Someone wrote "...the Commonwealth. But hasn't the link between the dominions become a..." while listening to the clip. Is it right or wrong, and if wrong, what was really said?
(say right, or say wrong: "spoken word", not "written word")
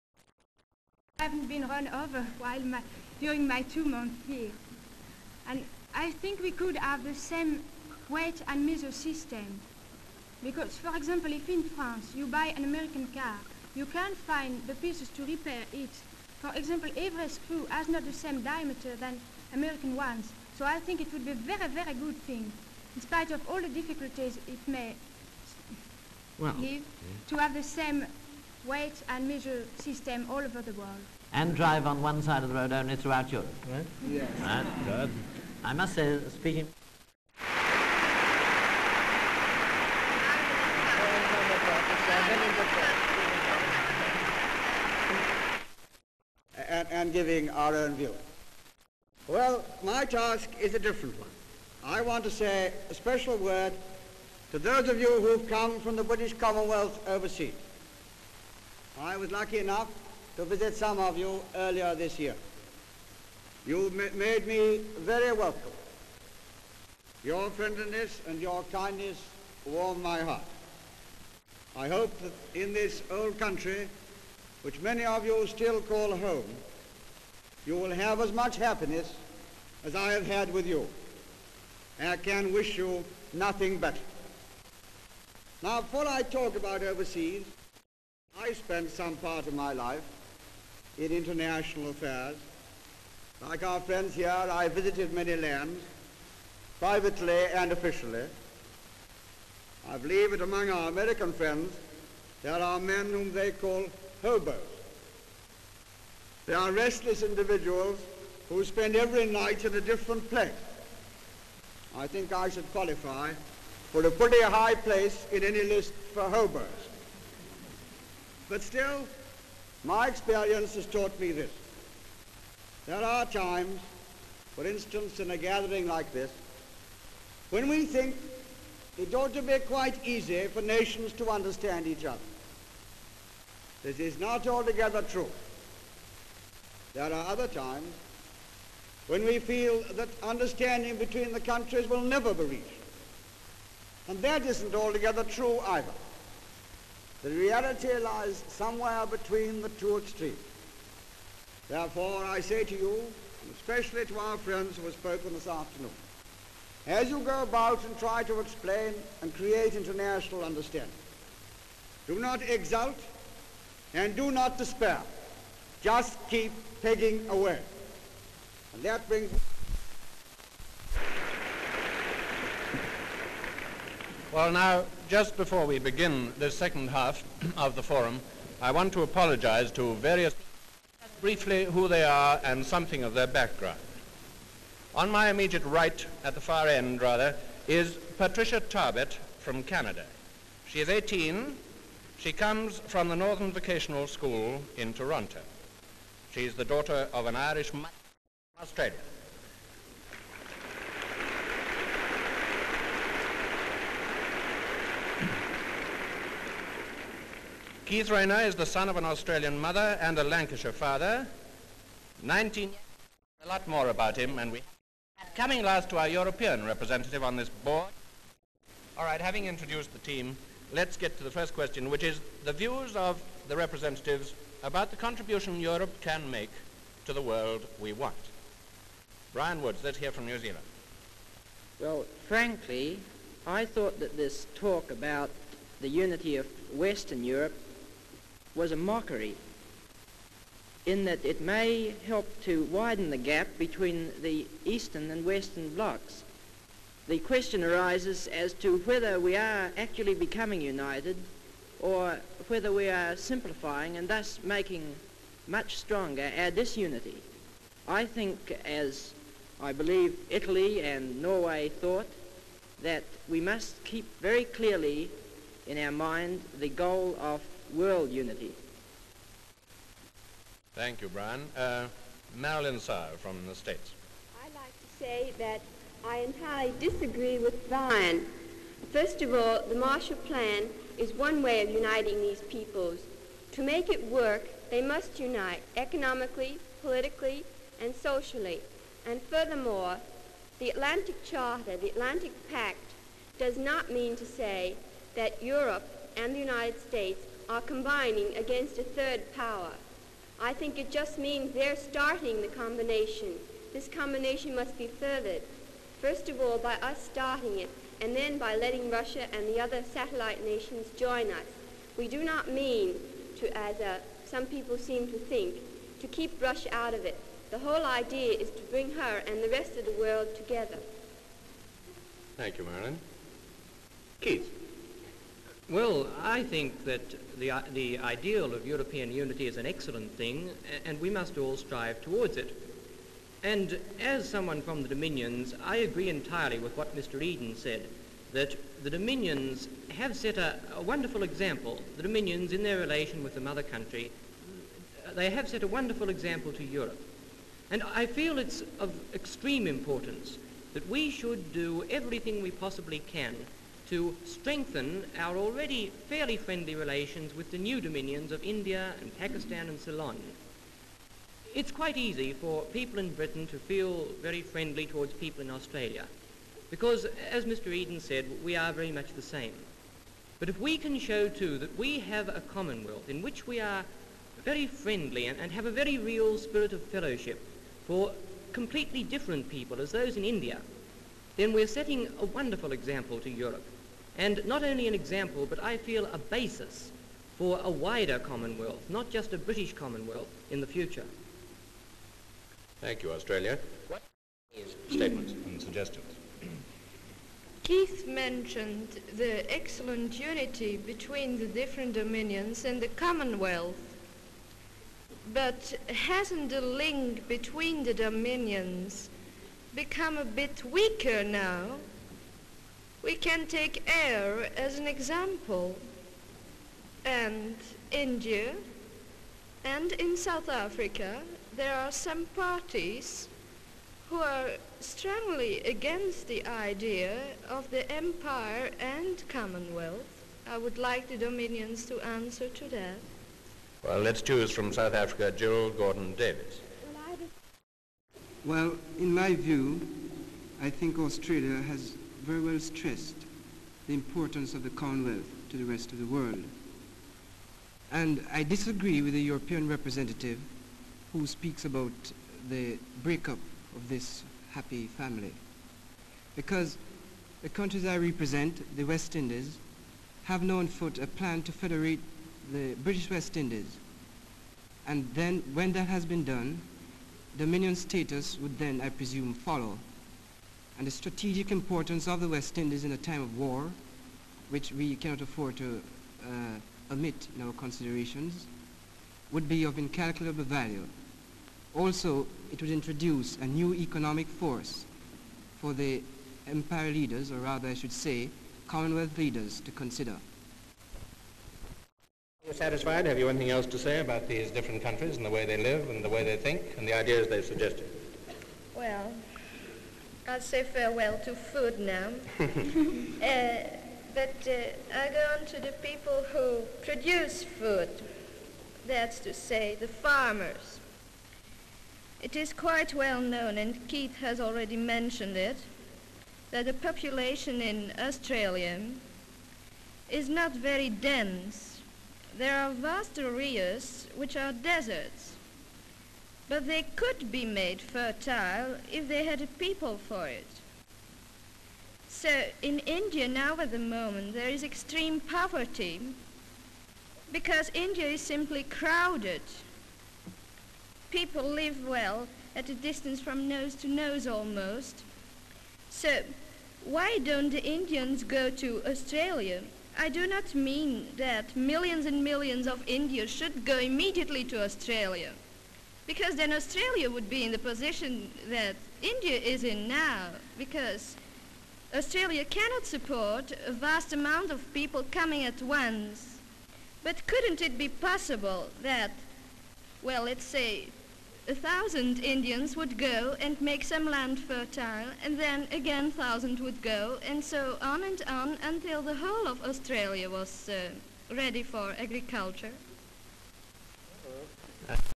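right.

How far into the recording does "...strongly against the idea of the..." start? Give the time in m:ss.
7:04.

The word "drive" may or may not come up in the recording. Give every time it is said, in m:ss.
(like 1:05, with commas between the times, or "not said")
0:31.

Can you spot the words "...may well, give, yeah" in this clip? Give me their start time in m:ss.
0:24.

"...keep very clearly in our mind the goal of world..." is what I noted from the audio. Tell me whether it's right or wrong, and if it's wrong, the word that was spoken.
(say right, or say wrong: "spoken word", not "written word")
right.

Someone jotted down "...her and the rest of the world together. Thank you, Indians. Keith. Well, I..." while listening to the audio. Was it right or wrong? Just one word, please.
wrong.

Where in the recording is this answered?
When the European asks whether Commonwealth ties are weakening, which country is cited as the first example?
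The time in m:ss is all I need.
6:53.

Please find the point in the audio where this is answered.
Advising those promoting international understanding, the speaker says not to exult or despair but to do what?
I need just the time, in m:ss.
2:46.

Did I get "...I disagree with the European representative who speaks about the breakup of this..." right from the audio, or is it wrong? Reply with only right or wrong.
right.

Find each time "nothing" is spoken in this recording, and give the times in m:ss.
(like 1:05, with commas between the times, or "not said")
1:23.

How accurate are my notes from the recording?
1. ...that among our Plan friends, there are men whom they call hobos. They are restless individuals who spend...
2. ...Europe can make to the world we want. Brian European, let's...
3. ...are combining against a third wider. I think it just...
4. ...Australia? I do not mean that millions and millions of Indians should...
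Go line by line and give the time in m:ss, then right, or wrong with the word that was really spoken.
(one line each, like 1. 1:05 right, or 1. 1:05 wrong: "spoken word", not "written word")
1. 1:40 wrong: "American", not "Plan"
2. 3:45 wrong: "Woods", not "European"
3. 4:57 wrong: "power", not "wider"
4. 9:08 right.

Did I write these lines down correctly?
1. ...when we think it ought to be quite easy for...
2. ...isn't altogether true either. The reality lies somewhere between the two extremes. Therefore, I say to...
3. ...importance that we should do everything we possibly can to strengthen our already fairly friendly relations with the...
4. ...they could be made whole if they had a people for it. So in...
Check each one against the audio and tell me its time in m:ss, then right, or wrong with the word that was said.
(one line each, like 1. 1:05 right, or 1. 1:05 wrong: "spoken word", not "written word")
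1. 2:07 right
2. 2:24 right
3. 5:49 right
4. 8:46 wrong: "fertile", not "whole".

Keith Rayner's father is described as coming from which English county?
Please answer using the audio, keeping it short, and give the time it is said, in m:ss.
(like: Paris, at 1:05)
Lancashire, at 3:30.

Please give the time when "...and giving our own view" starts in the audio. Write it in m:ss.
0:46.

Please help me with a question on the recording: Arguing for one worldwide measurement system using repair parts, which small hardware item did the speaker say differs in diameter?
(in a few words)
screw.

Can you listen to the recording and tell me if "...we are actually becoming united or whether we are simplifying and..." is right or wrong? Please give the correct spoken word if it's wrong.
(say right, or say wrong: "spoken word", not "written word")
right.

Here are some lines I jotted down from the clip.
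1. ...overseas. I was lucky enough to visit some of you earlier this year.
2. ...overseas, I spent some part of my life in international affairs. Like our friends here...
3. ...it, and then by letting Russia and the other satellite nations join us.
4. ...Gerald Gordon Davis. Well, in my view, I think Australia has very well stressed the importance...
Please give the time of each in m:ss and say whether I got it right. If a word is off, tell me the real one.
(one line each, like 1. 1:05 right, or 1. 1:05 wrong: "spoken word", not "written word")
1. 0:57 right
2. 1:26 right
3. 5:07 right
4. 7:15 right.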